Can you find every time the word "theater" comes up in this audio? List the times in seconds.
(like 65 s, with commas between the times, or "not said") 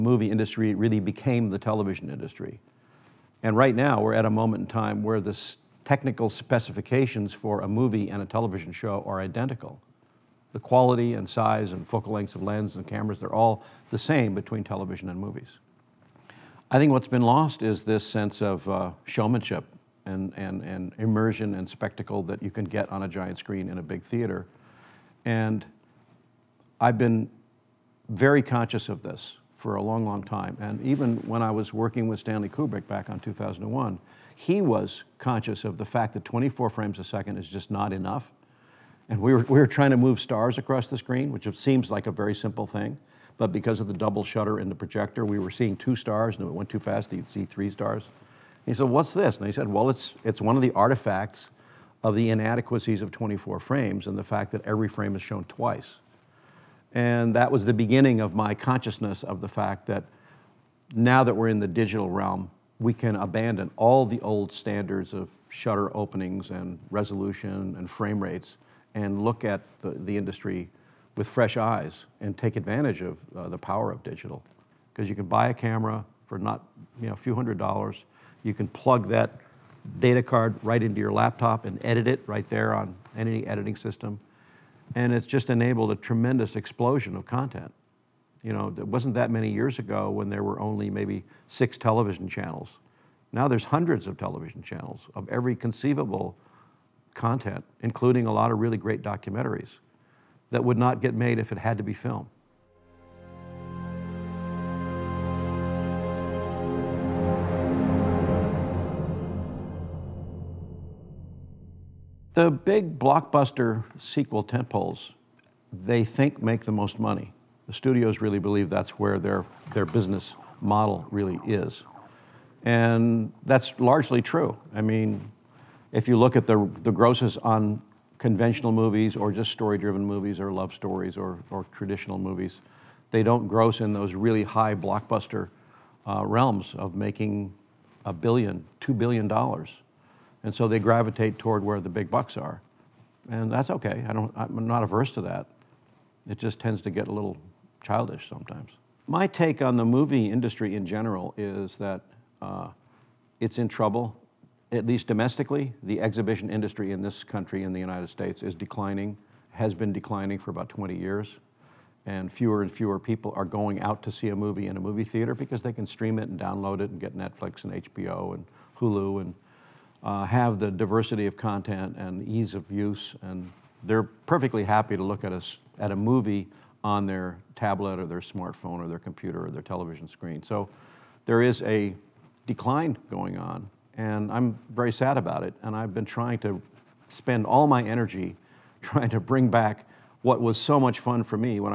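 24 s, 165 s.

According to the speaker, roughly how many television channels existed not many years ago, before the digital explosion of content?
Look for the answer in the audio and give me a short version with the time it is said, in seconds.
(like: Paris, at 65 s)
6, at 91 s.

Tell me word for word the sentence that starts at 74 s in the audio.
Because you can buy a camera for not, you know, a few hundred dollars.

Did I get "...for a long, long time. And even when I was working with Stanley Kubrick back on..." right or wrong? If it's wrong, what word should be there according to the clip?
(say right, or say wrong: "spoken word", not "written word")
right.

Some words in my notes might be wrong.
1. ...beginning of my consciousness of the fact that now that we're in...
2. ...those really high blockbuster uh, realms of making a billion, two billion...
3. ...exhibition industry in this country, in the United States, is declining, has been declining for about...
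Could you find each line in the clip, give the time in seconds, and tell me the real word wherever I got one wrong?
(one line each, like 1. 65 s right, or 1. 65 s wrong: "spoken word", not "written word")
1. 57 s right
2. 133 s right
3. 155 s right.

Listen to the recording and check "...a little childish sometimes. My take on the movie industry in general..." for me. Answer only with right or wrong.
right.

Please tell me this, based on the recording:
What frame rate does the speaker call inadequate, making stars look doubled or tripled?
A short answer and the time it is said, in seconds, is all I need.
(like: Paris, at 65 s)
24 frames a second, at 36 s.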